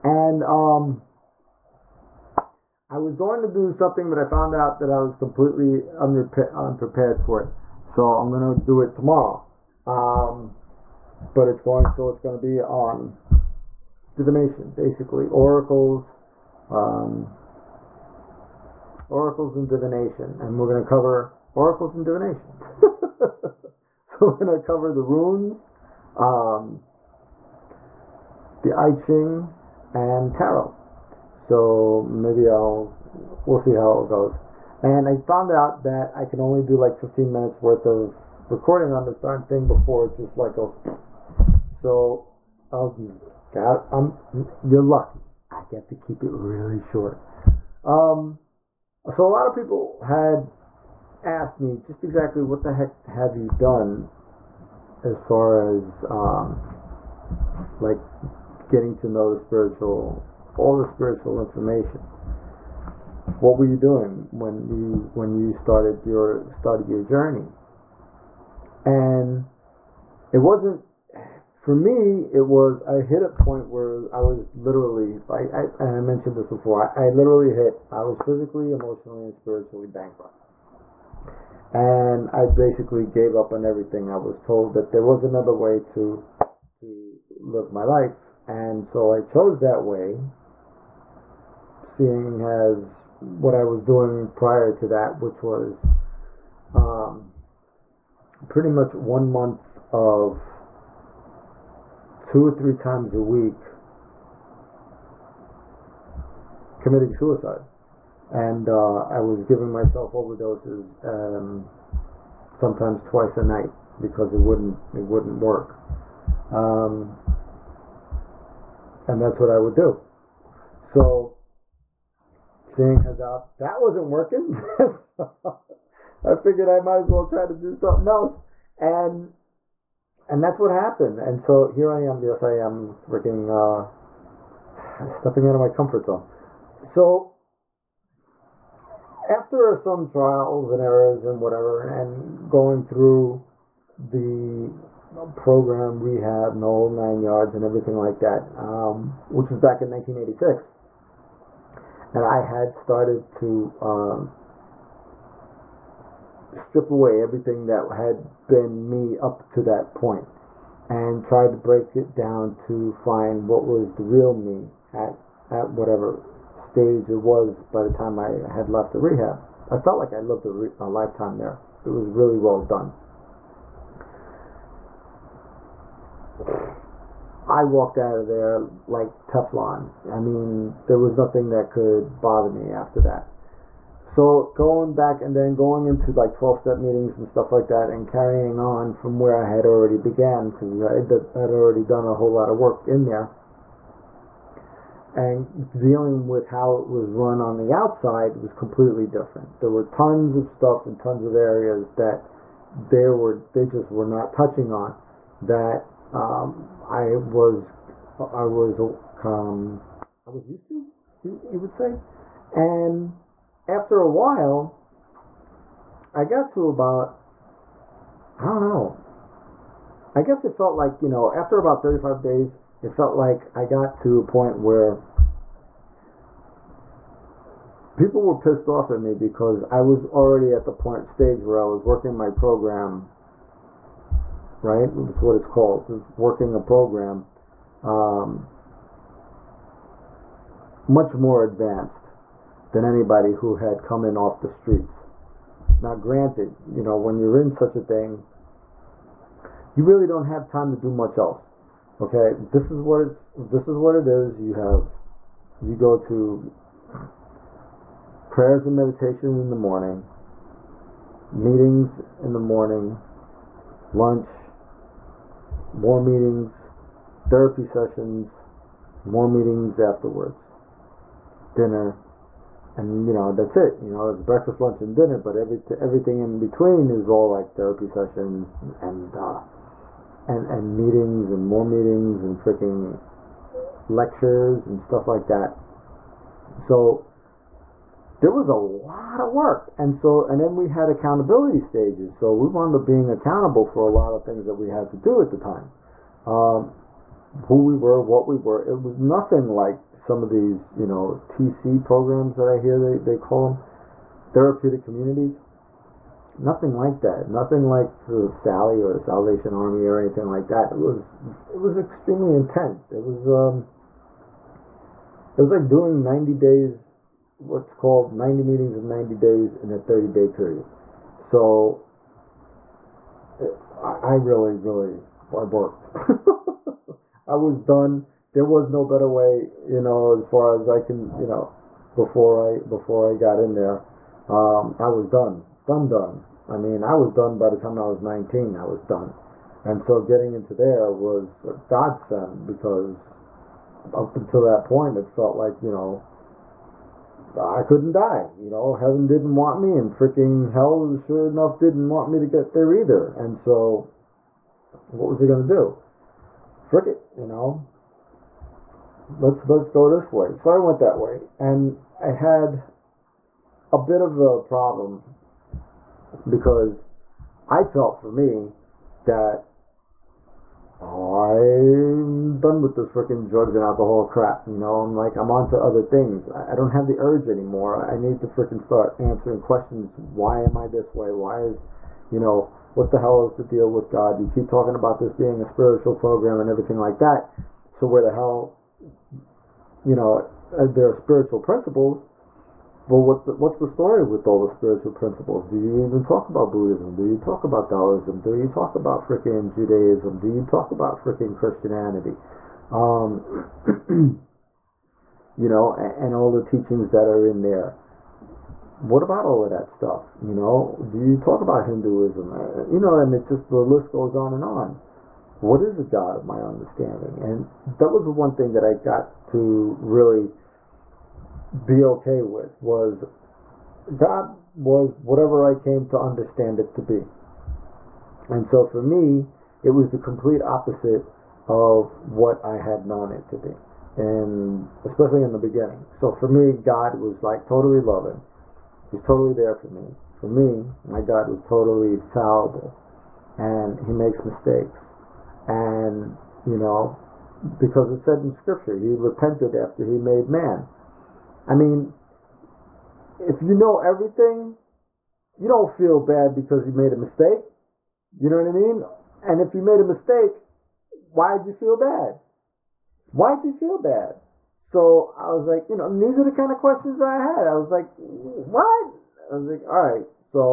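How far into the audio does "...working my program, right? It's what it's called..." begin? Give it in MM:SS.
03:51.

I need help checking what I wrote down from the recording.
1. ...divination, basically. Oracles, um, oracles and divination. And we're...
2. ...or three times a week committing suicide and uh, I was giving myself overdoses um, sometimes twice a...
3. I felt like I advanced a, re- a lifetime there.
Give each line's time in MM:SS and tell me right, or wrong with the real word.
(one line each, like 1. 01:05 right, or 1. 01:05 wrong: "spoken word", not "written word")
1. 00:14 right
2. 01:42 right
3. 02:49 wrong: "lived", not "advanced".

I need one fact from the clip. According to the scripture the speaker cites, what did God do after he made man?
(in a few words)
repented.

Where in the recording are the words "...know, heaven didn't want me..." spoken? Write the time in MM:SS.
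05:48.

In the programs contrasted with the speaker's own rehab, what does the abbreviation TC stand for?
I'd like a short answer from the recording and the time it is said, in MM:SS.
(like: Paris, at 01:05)
therapeutic communities, at 05:04.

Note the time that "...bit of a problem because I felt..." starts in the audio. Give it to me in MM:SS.
06:03.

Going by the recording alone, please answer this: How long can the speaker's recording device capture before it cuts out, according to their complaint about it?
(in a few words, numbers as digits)
15 minutes.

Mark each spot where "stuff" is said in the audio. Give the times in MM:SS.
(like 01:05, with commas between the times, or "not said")
03:07, 03:20, 04:44, 06:49.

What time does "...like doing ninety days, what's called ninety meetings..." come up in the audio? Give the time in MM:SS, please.
05:15.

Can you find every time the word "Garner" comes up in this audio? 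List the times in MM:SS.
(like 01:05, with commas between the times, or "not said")
not said.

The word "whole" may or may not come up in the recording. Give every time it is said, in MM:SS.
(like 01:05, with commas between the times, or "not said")
02:26, 03:12.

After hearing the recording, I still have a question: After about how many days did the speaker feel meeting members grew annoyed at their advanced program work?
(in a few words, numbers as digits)
35 days.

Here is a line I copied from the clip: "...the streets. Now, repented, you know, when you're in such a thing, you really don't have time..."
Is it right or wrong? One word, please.
wrong.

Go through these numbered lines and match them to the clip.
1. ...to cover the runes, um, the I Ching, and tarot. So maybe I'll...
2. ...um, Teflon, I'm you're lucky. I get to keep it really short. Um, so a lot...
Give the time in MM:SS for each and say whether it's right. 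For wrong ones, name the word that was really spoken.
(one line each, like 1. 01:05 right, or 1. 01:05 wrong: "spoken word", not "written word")
1. 00:24 right
2. 00:42 wrong: "God", not "Teflon".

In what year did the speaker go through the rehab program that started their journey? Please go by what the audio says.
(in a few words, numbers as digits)
1986.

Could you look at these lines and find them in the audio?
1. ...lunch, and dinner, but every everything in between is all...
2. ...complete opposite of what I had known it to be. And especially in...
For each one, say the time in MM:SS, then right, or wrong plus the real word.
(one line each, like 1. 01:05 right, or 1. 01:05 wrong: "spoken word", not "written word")
1. 04:34 right
2. 07:09 right.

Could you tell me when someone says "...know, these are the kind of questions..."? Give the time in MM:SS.
07:45.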